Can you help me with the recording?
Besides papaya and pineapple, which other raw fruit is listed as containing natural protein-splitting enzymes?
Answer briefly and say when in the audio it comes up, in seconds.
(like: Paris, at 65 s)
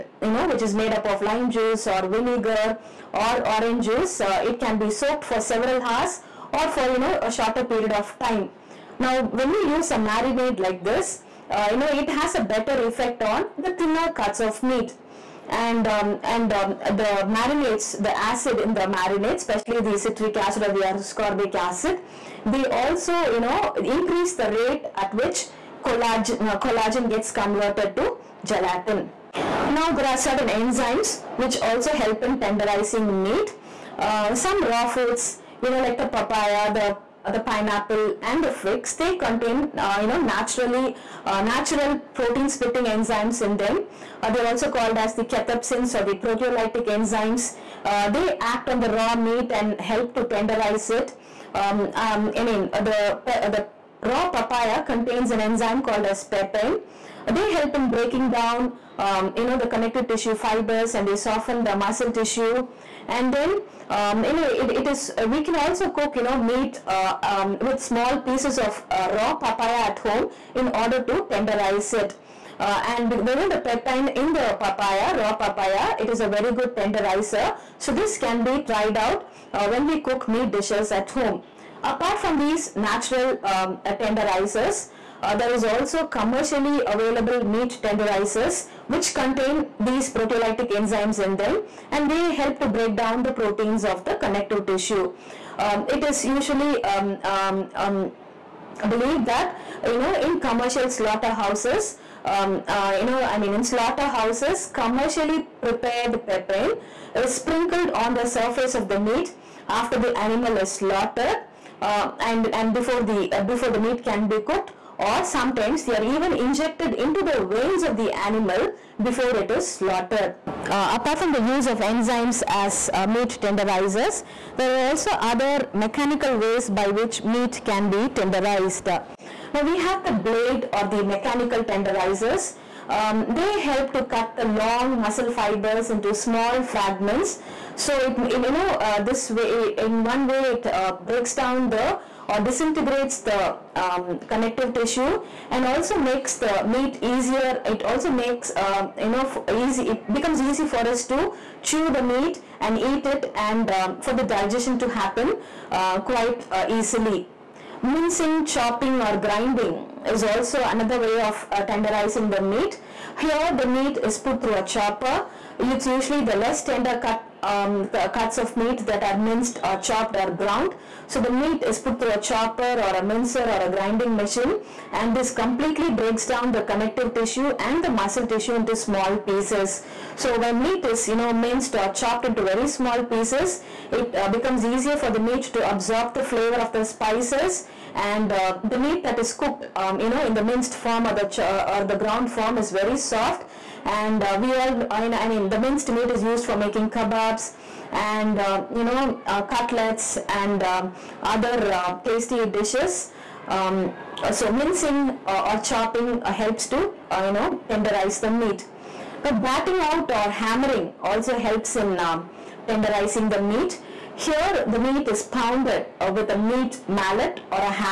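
figs, at 38 s.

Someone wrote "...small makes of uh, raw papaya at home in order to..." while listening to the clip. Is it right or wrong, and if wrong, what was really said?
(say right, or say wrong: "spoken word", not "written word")
wrong: "pieces", not "makes".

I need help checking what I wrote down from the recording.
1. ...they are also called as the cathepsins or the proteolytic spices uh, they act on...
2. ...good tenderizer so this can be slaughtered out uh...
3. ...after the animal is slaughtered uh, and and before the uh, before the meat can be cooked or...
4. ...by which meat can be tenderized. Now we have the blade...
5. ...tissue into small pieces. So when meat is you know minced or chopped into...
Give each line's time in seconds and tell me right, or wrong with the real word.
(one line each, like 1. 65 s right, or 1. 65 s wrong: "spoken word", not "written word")
1. 44 s wrong: "enzymes", not "spices"
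2. 76 s wrong: "tried", not "slaughtered"
3. 109 s right
4. 126 s right
5. 178 s right.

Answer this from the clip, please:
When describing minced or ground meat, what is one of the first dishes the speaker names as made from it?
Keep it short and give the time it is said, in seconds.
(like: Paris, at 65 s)
kebabs, at 196 s.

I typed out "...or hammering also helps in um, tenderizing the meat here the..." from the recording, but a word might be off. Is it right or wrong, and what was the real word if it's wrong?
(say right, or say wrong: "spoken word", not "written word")
right.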